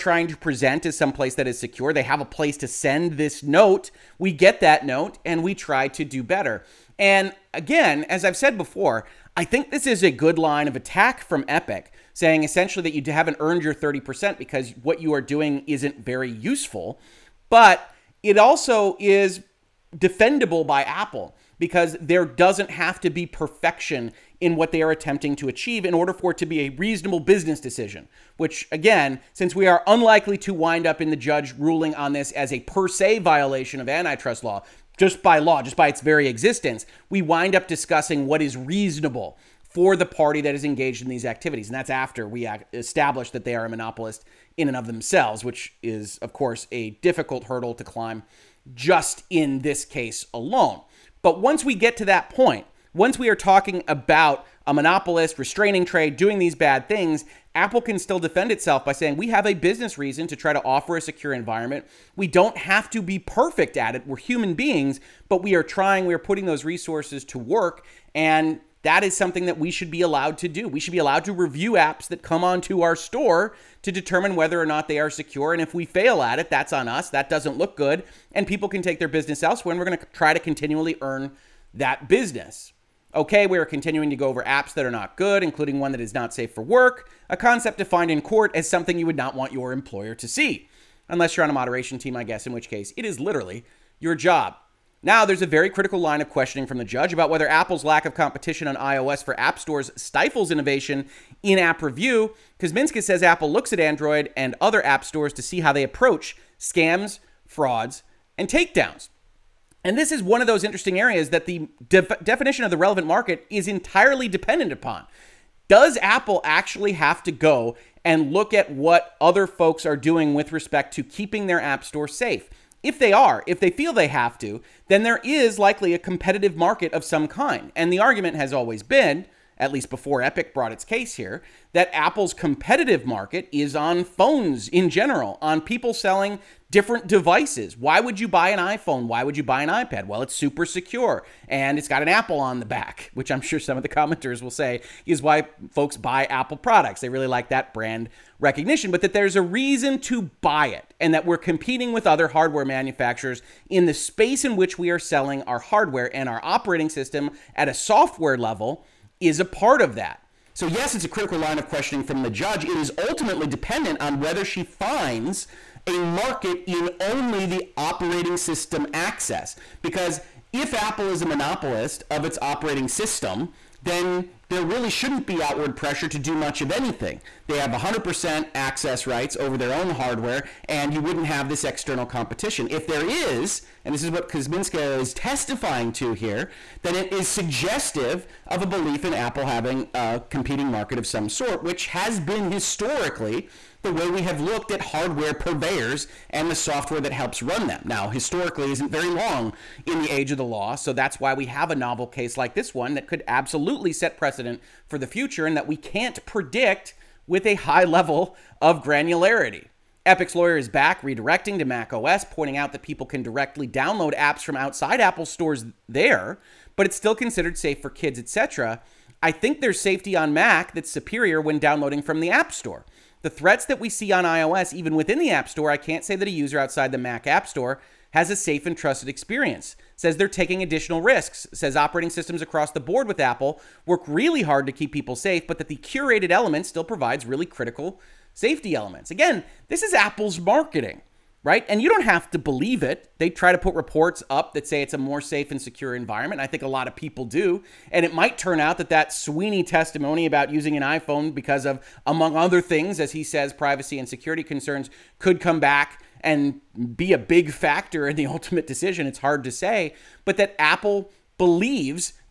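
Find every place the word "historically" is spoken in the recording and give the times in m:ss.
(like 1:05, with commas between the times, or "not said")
3:12, 3:18.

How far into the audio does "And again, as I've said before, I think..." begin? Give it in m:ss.
0:06.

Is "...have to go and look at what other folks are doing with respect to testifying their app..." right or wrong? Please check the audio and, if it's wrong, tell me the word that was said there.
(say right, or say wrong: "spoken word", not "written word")
wrong: "keeping", not "testifying".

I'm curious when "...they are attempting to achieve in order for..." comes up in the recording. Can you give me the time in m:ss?
0:24.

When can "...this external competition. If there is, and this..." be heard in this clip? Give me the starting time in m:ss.
3:01.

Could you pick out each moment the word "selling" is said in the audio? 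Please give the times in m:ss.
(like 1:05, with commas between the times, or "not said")
2:15, 2:34.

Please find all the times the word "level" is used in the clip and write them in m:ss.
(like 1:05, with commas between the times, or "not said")
2:38, 3:27.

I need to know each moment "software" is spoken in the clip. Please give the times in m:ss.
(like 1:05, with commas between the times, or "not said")
2:37, 3:16.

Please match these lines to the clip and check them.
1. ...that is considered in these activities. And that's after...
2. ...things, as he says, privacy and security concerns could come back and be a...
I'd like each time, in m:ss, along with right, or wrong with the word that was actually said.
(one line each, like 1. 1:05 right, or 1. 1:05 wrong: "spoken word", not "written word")
1. 0:40 wrong: "engaged", not "considered"
2. 4:12 right.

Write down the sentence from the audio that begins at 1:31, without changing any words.
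Unless you're on a moderation team, I guess, in which case it is literally your job.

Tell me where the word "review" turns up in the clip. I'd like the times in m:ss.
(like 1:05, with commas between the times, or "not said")
1:11, 1:41.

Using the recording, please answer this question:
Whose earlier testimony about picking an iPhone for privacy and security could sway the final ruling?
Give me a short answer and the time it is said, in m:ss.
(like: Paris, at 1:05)
Sweeney, at 4:09.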